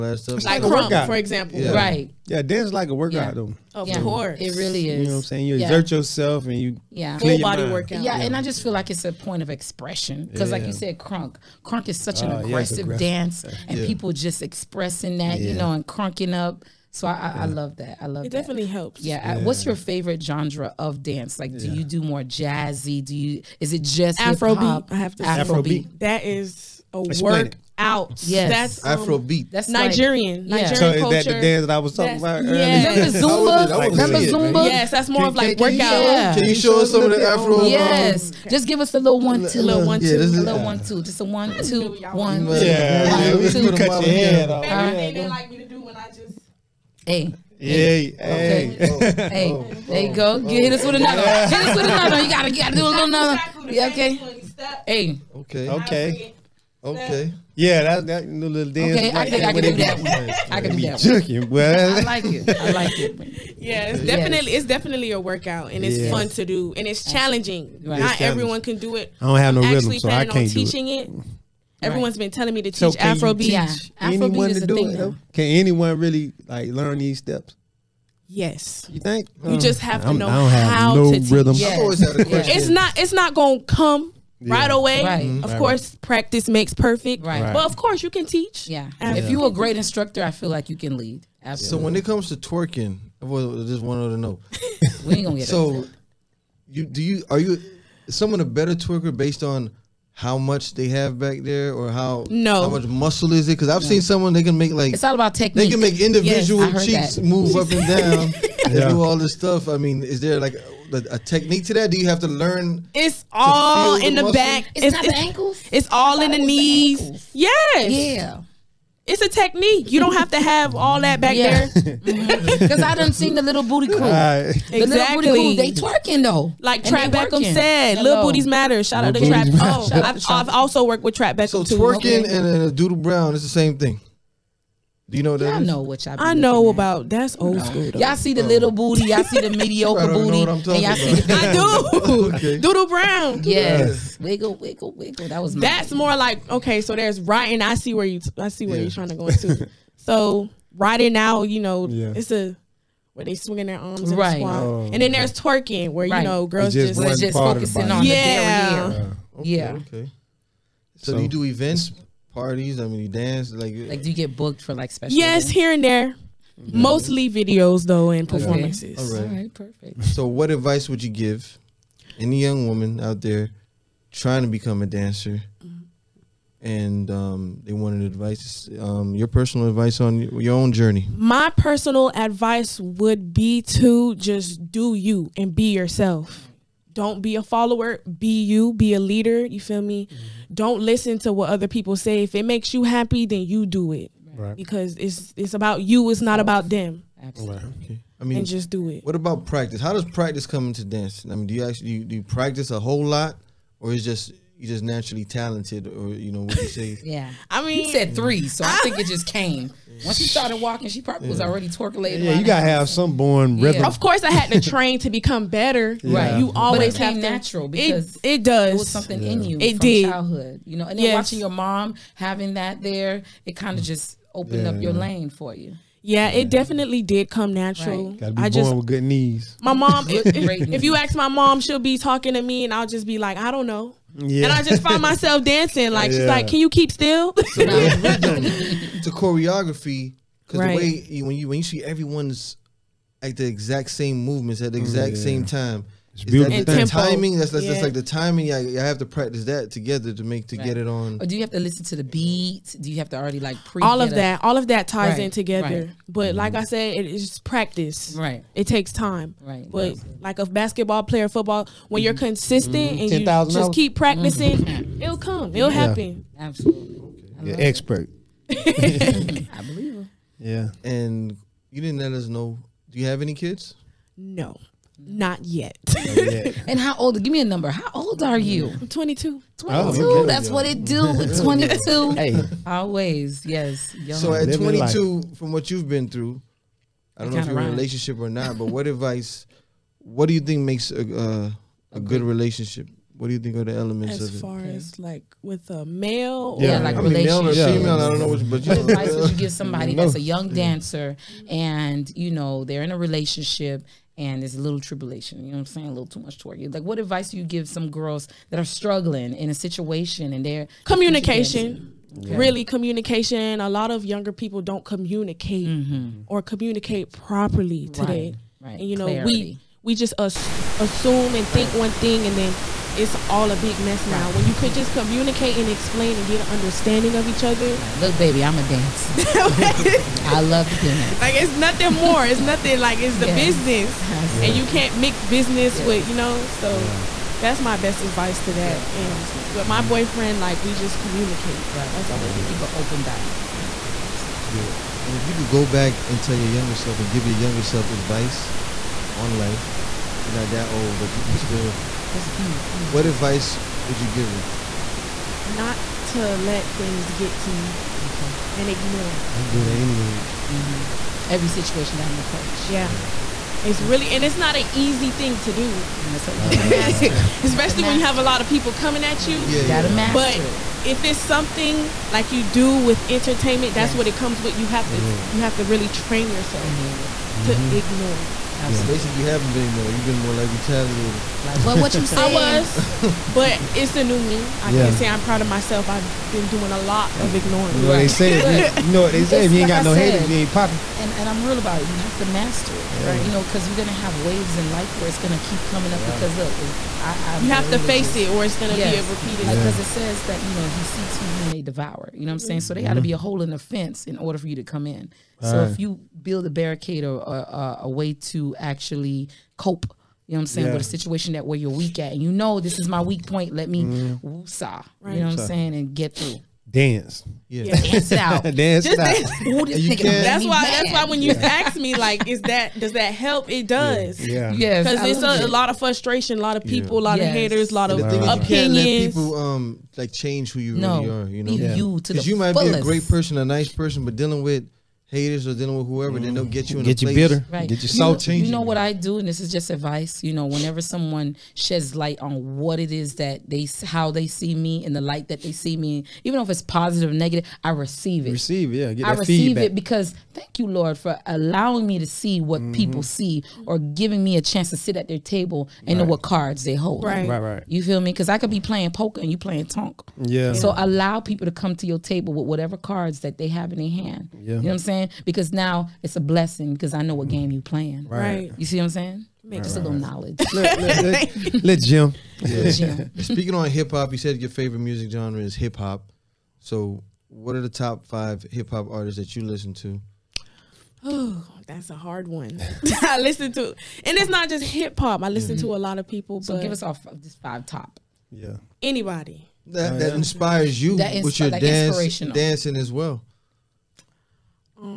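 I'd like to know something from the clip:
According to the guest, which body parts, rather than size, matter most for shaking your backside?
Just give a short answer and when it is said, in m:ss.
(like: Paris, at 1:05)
the knees, at 1:55.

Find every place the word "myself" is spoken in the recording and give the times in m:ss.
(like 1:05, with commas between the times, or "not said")
3:55, 6:25.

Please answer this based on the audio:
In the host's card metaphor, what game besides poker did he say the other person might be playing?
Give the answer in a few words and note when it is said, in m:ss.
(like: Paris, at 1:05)
tonk, at 7:39.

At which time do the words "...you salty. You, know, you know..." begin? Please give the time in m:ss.
7:17.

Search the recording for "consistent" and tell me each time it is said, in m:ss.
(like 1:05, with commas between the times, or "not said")
4:22.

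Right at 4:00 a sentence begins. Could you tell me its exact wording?
the way you, when you when you see everyone's at the exact same movements at the exact yeah.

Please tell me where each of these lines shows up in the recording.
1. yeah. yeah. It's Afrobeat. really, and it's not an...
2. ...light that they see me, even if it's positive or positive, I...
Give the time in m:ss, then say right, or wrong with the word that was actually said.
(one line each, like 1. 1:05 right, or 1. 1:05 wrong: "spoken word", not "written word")
1. 6:02 wrong: "Absolutely", not "Afrobeat"
2. 7:24 wrong: "negative", not "positive".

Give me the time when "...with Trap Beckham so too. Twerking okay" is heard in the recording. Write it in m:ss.
2:11.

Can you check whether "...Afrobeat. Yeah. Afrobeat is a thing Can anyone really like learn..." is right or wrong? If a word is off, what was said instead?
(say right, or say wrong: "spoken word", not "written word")
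right.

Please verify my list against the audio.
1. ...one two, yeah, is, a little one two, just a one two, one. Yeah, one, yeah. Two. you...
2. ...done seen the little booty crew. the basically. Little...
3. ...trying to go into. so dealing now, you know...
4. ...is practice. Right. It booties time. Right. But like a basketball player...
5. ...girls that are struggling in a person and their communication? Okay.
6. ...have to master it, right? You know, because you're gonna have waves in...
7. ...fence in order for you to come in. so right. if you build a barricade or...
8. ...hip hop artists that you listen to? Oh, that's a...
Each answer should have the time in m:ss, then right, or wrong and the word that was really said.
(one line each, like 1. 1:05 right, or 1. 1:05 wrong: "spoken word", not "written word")
1. 0:39 right
2. 2:02 wrong: "exactly", not "basically"
3. 2:28 wrong: "writing", not "dealing"
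4. 4:17 wrong: "takes", not "booties"
5. 5:07 wrong: "situation", not "person"
6. 6:31 right
7. 6:43 right
8. 7:58 right.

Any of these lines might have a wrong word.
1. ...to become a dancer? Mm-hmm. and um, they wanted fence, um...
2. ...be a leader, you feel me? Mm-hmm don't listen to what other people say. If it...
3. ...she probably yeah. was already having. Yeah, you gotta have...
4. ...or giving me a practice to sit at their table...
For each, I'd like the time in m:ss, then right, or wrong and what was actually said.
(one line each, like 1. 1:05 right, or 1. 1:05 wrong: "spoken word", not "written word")
1. 2:54 wrong: "advice", not "fence"
2. 3:08 right
3. 3:30 wrong: "twerkulating", not "having"
4. 7:33 wrong: "chance", not "practice".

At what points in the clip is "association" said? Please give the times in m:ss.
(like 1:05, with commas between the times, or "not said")
not said.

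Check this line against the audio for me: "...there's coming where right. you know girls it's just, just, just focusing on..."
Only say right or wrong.
wrong.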